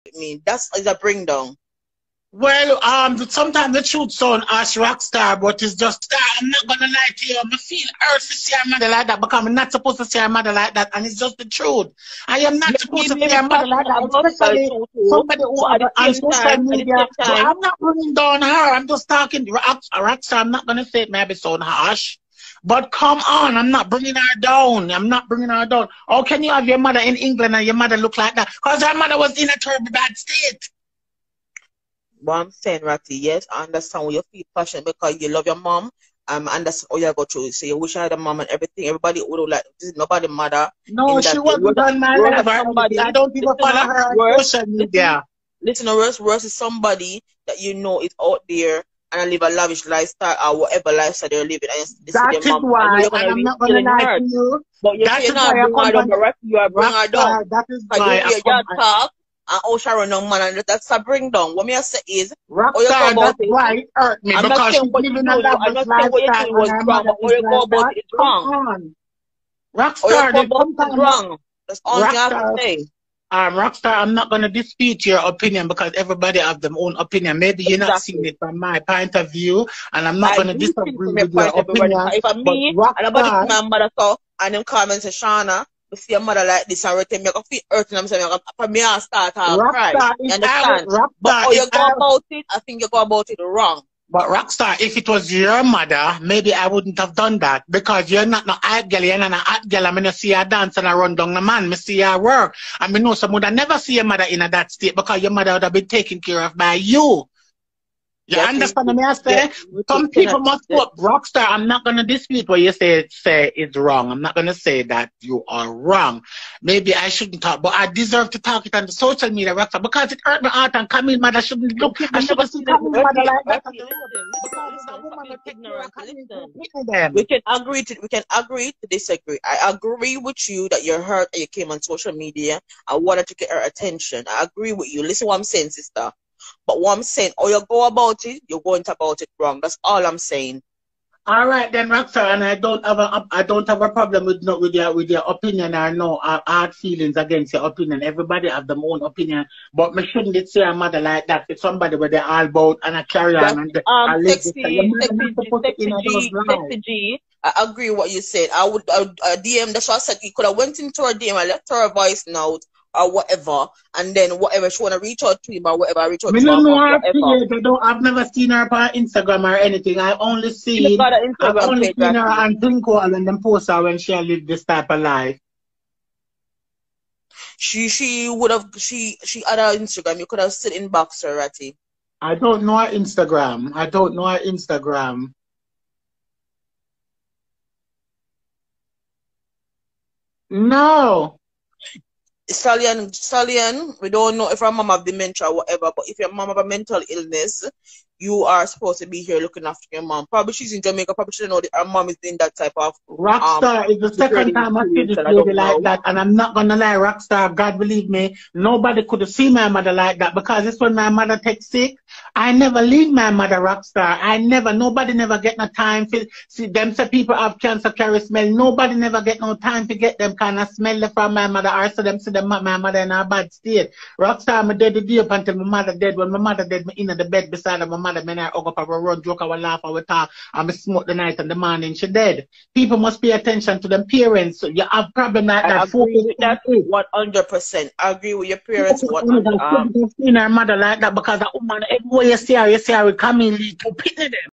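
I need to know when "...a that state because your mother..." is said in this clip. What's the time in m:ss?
1:44.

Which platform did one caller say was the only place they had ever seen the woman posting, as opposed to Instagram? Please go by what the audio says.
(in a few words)
Twinkle.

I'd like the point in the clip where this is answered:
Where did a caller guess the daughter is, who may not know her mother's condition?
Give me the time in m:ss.
3:20.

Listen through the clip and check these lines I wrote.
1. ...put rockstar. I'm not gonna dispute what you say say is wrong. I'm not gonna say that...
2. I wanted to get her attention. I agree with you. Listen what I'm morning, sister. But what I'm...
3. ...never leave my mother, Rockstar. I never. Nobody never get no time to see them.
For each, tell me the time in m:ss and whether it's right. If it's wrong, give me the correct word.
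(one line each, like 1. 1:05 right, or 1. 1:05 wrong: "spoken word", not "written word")
1. 1:50 right
2. 2:12 wrong: "saying", not "morning"
3. 3:32 right.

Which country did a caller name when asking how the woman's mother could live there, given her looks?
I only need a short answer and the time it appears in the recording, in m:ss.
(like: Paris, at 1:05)
England, at 0:27.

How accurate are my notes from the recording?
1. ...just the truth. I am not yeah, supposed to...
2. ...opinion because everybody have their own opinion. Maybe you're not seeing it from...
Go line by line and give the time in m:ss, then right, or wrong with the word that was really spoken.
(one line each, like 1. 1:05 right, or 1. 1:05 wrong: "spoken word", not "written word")
1. 0:11 right
2. 1:15 right.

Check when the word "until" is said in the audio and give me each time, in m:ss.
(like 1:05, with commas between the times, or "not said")
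3:45.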